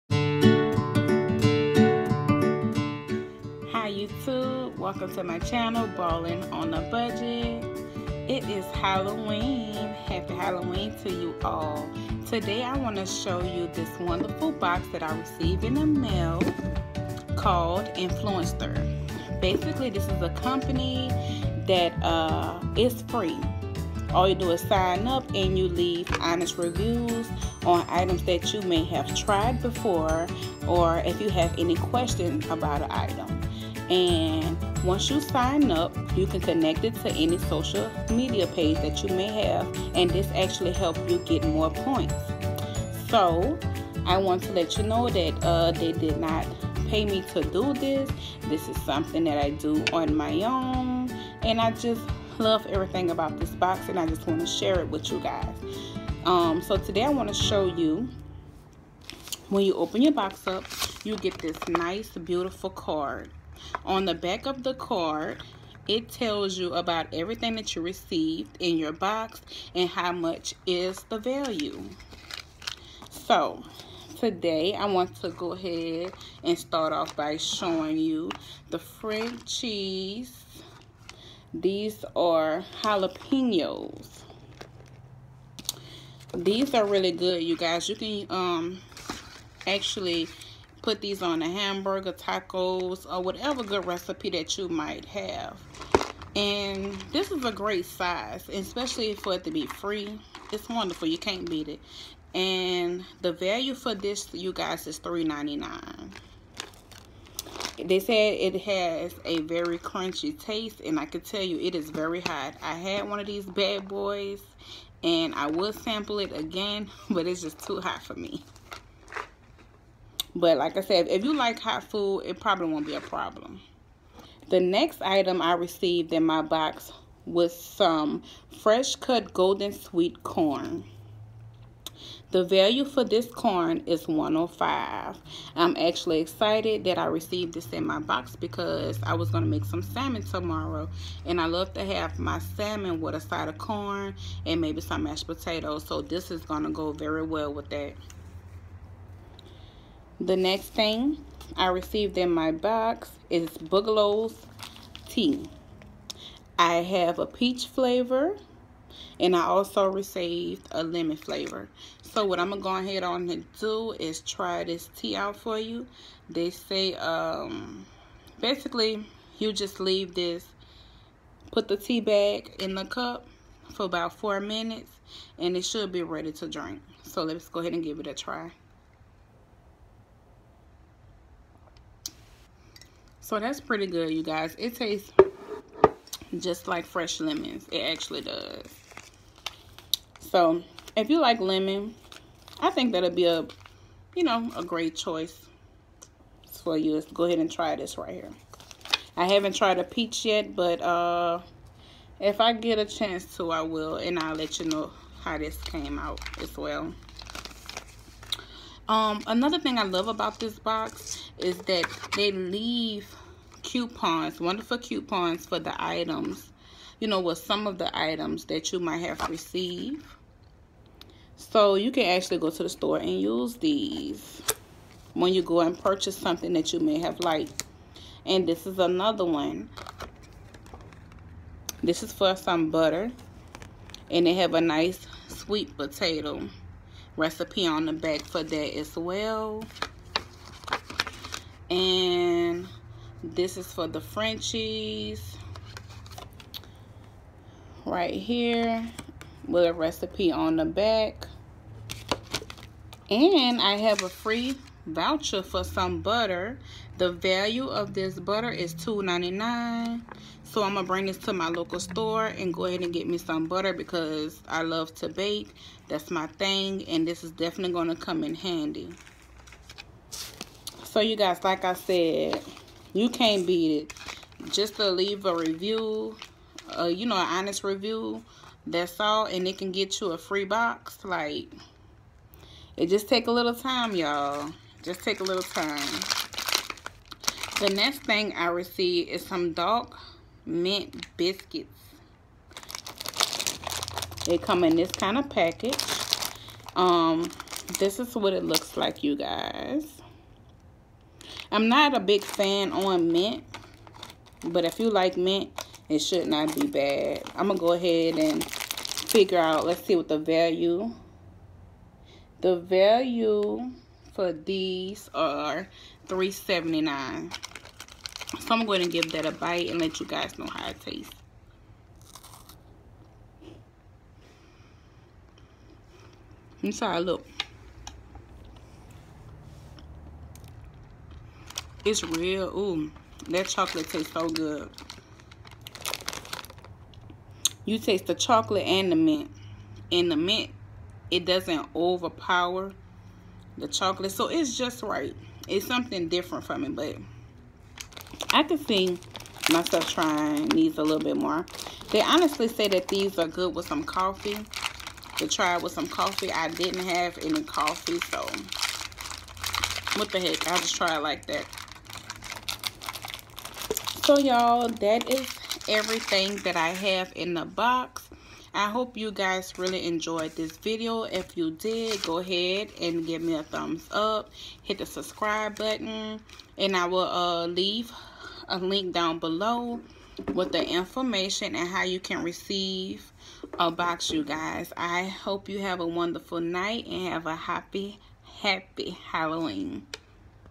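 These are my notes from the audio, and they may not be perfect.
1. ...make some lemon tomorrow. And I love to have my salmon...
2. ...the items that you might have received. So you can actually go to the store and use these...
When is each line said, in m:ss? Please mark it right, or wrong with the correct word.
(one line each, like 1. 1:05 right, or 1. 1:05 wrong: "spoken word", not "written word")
1. 2:19 wrong: "salmon", not "lemon"
2. 3:37 right.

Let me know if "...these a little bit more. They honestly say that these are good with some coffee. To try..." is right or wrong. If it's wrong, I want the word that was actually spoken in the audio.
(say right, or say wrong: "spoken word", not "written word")
right.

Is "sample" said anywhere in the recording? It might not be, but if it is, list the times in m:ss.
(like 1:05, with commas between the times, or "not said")
1:55.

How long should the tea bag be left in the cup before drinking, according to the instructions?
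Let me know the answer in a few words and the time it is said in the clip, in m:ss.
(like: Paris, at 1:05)
4 minutes, at 2:54.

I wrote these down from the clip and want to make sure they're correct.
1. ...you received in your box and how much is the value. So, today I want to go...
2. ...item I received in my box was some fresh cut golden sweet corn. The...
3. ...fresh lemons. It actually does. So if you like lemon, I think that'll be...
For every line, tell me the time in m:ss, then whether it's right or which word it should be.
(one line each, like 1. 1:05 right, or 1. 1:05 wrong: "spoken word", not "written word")
1. 1:07 right
2. 2:05 right
3. 3:06 right.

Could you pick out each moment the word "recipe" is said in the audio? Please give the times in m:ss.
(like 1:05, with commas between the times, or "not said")
1:33, 3:57, 4:09.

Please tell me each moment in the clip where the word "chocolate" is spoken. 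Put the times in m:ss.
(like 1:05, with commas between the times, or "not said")
5:33, 5:38, 5:43.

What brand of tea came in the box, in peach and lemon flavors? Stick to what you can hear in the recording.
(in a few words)
Bigelow's.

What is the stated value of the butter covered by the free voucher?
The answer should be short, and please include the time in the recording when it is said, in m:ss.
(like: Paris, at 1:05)
$2.99, at 4:18.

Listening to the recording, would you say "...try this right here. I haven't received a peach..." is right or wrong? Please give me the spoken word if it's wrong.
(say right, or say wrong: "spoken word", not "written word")
wrong: "tried", not "received".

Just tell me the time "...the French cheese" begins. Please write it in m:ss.
1:18.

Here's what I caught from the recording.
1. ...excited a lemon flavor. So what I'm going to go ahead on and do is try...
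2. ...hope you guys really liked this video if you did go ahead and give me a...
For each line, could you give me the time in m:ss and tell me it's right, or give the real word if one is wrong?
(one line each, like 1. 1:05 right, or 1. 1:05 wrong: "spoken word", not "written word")
1. 2:39 wrong: "received", not "excited"
2. 6:08 wrong: "enjoyed", not "liked".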